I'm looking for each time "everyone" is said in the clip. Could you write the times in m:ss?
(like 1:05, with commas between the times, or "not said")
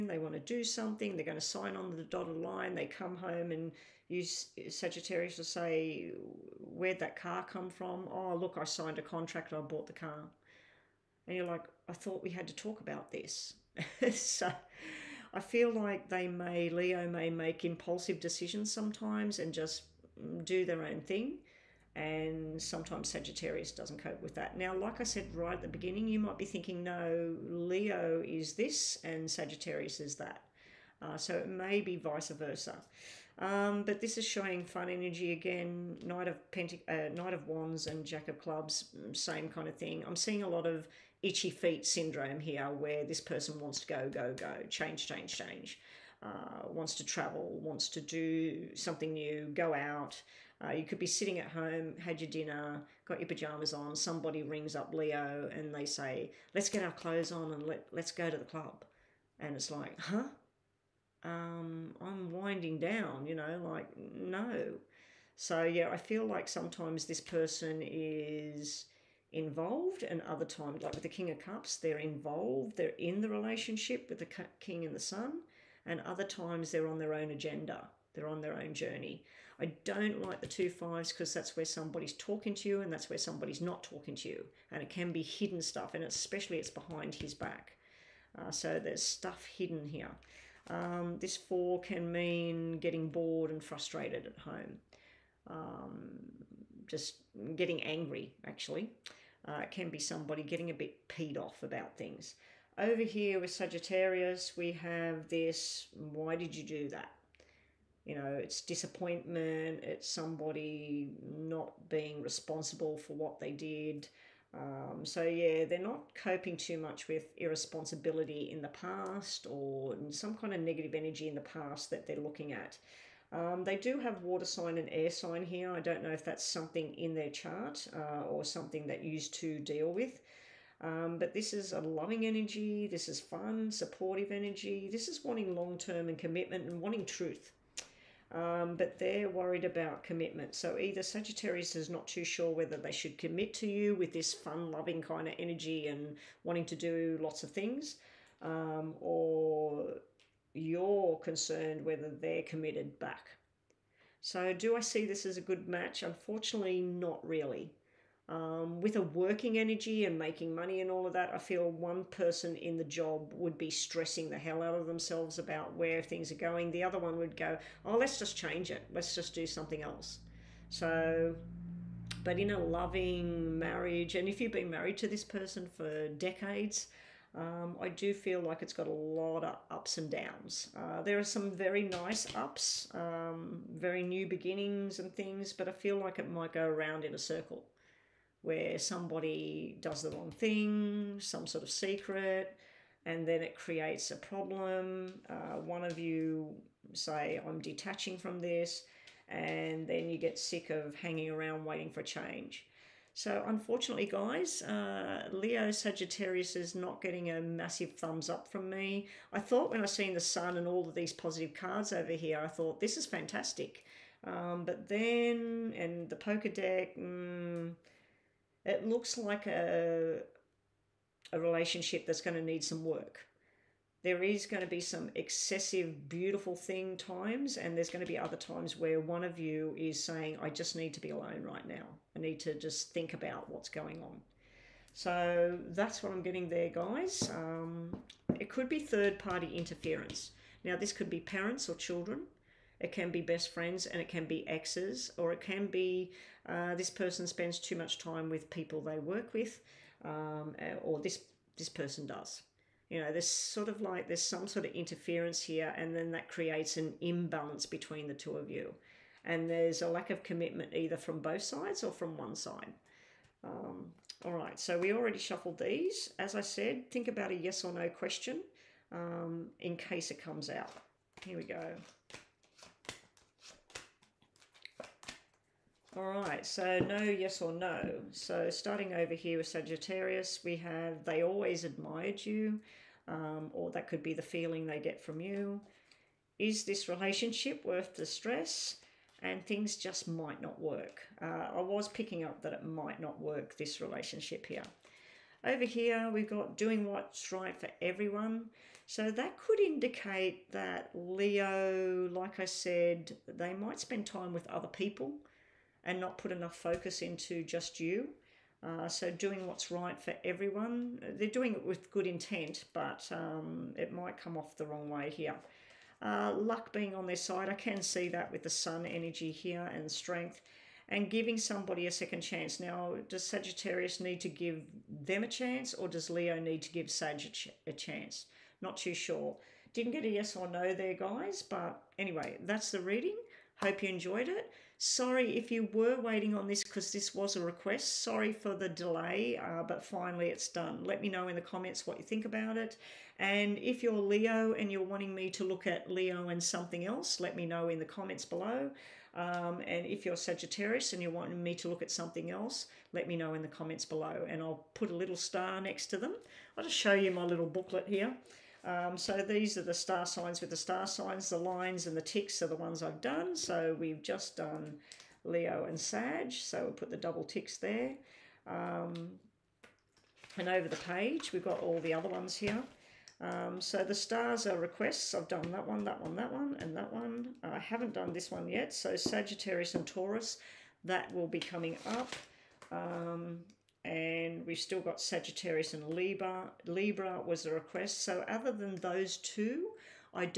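4:57, 5:10.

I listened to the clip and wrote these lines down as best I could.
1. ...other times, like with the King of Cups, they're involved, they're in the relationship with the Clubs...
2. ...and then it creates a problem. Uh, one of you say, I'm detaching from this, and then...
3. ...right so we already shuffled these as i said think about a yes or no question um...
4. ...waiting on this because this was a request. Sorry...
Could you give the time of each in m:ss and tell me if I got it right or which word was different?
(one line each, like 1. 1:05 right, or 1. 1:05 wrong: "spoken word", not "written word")
1. 1:10 wrong: "King", not "Clubs"
2. 3:13 right
3. 4:24 right
4. 5:36 right.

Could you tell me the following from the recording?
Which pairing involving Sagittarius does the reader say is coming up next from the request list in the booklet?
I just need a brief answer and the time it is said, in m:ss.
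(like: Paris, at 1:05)
Sagittarius and Taurus, at 6:18.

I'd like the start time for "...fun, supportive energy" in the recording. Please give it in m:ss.
2:13.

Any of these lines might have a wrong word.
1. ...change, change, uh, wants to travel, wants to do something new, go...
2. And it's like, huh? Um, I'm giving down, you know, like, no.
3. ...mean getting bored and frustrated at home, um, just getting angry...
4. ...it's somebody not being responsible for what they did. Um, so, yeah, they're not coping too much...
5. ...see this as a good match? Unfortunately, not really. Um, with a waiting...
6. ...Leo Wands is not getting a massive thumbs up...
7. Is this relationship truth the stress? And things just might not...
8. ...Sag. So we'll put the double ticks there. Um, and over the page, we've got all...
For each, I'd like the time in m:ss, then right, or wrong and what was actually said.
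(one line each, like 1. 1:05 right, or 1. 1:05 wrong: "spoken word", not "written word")
1. 0:45 right
2. 0:59 wrong: "winding", not "giving"
3. 1:32 right
4. 1:49 right
5. 2:34 wrong: "working", not "waiting"
6. 3:25 wrong: "Sagittarius", not "Wands"
7. 4:46 wrong: "worth", not "truth"
8. 6:05 right.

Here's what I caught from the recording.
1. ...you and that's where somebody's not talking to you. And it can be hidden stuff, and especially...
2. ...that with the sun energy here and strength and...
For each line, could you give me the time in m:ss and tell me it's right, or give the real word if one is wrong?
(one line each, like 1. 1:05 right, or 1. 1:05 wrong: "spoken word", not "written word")
1. 1:22 right
2. 5:18 right.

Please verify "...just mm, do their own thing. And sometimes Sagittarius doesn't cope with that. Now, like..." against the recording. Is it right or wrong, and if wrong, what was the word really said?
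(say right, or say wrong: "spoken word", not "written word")
right.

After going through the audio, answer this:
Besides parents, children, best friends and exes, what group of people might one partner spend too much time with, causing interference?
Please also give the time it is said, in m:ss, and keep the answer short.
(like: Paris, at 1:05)
People they work with, at 4:08.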